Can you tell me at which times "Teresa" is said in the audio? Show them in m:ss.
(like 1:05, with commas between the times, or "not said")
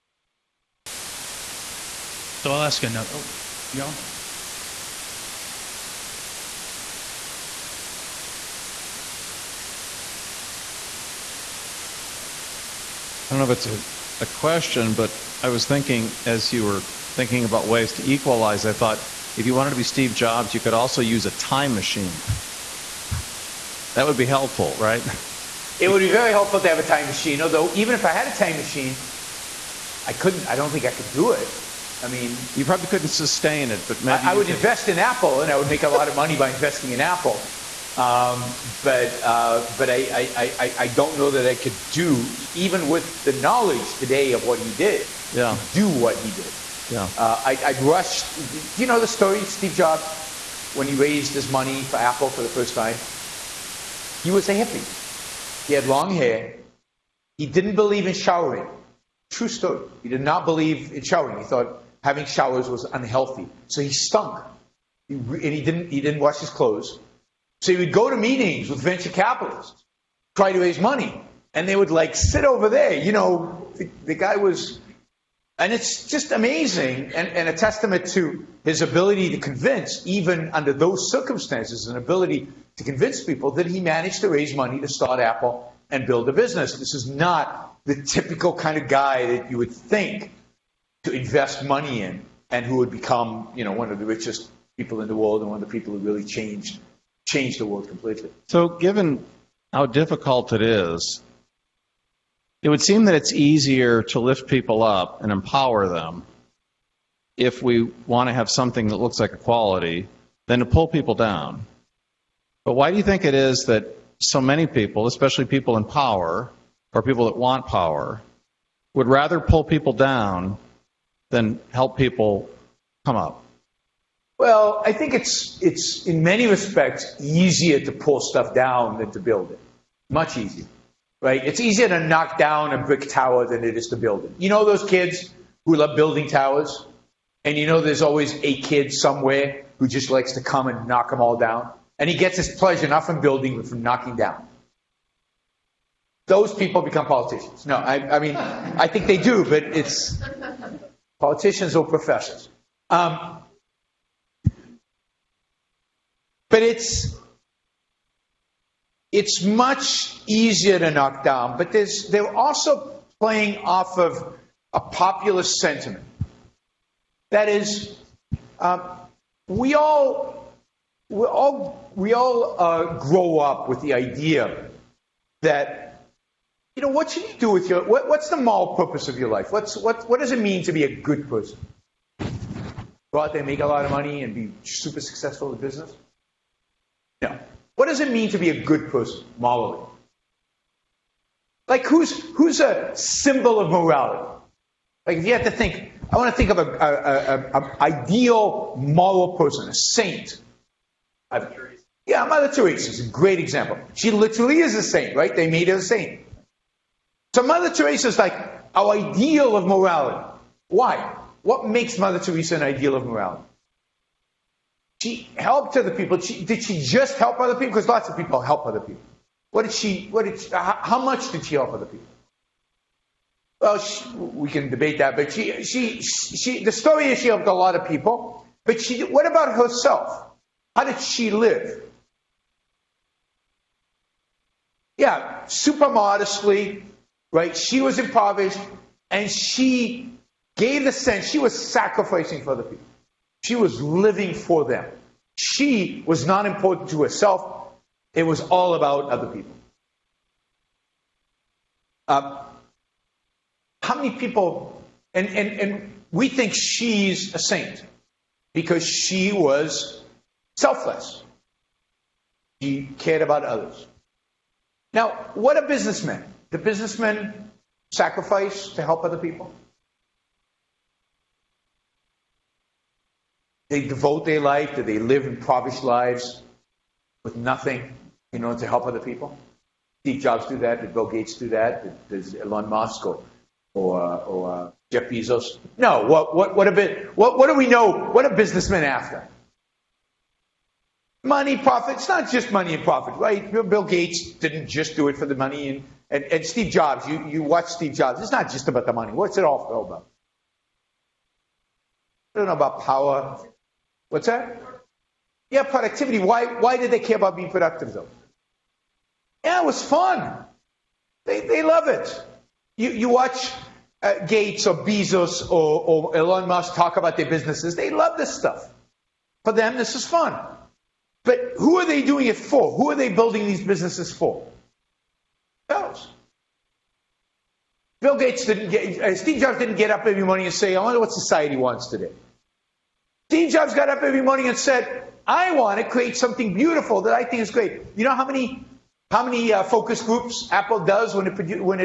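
3:22, 3:27, 3:32.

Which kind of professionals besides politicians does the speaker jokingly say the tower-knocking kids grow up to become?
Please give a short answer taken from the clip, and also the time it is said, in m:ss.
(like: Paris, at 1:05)
Professors, at 2:31.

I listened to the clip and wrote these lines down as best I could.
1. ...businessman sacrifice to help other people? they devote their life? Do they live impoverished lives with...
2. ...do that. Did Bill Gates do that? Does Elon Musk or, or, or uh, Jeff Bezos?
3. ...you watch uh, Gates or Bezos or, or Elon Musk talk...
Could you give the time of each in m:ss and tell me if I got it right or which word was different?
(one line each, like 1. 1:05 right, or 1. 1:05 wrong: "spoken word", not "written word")
1. 4:26 right
2. 4:40 right
3. 5:12 right.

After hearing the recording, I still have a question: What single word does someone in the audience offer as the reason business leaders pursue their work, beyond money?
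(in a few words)
Productivity.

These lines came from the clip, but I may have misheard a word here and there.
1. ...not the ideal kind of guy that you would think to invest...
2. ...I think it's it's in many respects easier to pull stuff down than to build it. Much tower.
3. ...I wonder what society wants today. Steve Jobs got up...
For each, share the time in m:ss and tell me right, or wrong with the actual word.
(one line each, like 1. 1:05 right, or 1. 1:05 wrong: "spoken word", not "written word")
1. 1:27 wrong: "typical", not "ideal"
2. 2:04 wrong: "easier", not "tower"
3. 5:30 right.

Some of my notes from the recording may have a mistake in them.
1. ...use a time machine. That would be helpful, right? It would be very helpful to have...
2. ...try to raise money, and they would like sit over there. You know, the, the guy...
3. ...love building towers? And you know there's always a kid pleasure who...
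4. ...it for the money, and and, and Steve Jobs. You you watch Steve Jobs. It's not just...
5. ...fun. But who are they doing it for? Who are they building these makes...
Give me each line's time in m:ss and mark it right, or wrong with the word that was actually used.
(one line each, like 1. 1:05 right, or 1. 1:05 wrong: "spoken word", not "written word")
1. 0:21 right
2. 1:10 right
3. 2:15 wrong: "somewhere", not "pleasure"
4. 4:55 right
5. 5:20 wrong: "businesses", not "makes".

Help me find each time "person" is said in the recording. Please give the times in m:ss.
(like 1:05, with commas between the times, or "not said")
3:01, 3:08, 3:19.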